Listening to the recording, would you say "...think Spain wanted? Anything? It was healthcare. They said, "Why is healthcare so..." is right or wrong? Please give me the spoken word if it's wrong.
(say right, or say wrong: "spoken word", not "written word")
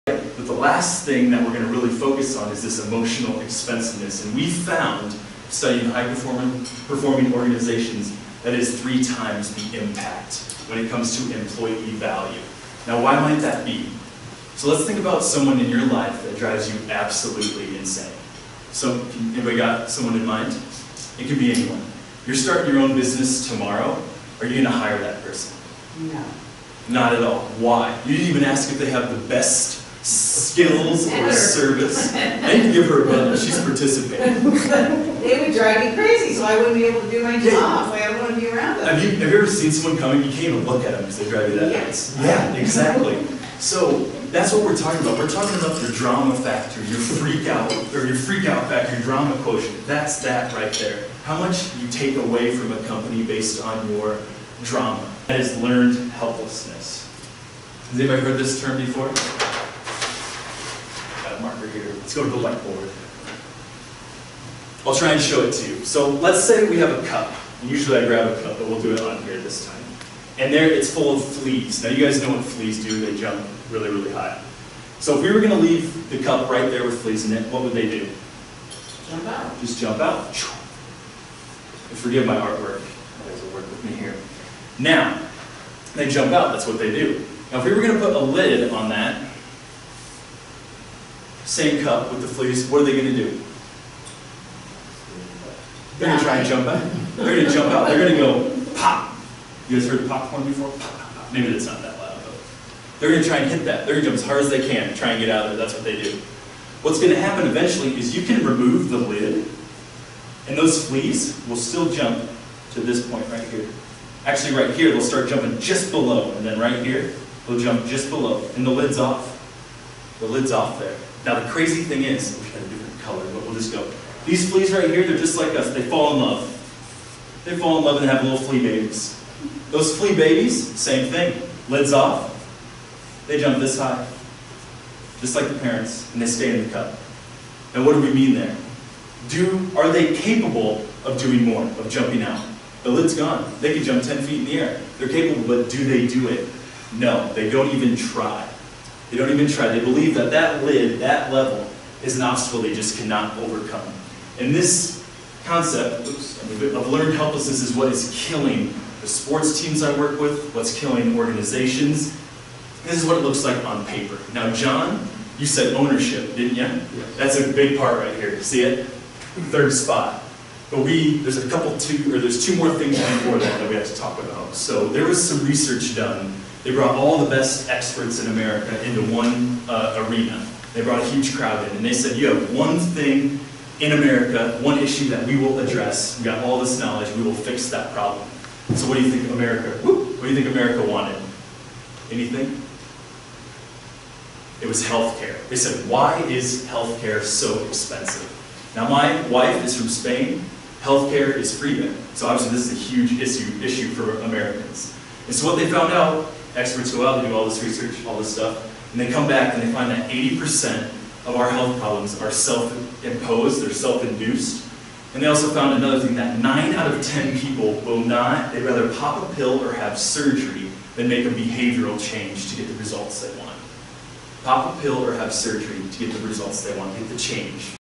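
wrong: "America", not "Spain".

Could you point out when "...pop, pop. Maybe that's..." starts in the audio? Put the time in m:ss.
1:40.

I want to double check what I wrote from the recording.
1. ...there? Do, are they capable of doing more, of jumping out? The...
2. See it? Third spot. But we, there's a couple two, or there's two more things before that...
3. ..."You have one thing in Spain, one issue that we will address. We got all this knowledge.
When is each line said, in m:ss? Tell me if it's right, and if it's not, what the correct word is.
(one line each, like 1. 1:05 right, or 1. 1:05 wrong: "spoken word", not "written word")
1. 2:18 right
2. 2:48 right
3. 3:02 wrong: "America", not "Spain".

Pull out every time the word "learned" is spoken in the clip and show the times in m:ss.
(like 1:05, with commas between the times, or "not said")
0:55, 2:36.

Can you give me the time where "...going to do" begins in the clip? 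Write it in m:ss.
1:32.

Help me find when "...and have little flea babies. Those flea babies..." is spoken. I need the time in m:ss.
2:08.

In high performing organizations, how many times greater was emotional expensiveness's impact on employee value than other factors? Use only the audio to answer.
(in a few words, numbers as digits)
3 times.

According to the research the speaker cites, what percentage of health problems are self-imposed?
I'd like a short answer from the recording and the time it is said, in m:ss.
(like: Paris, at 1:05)
80%, at 3:30.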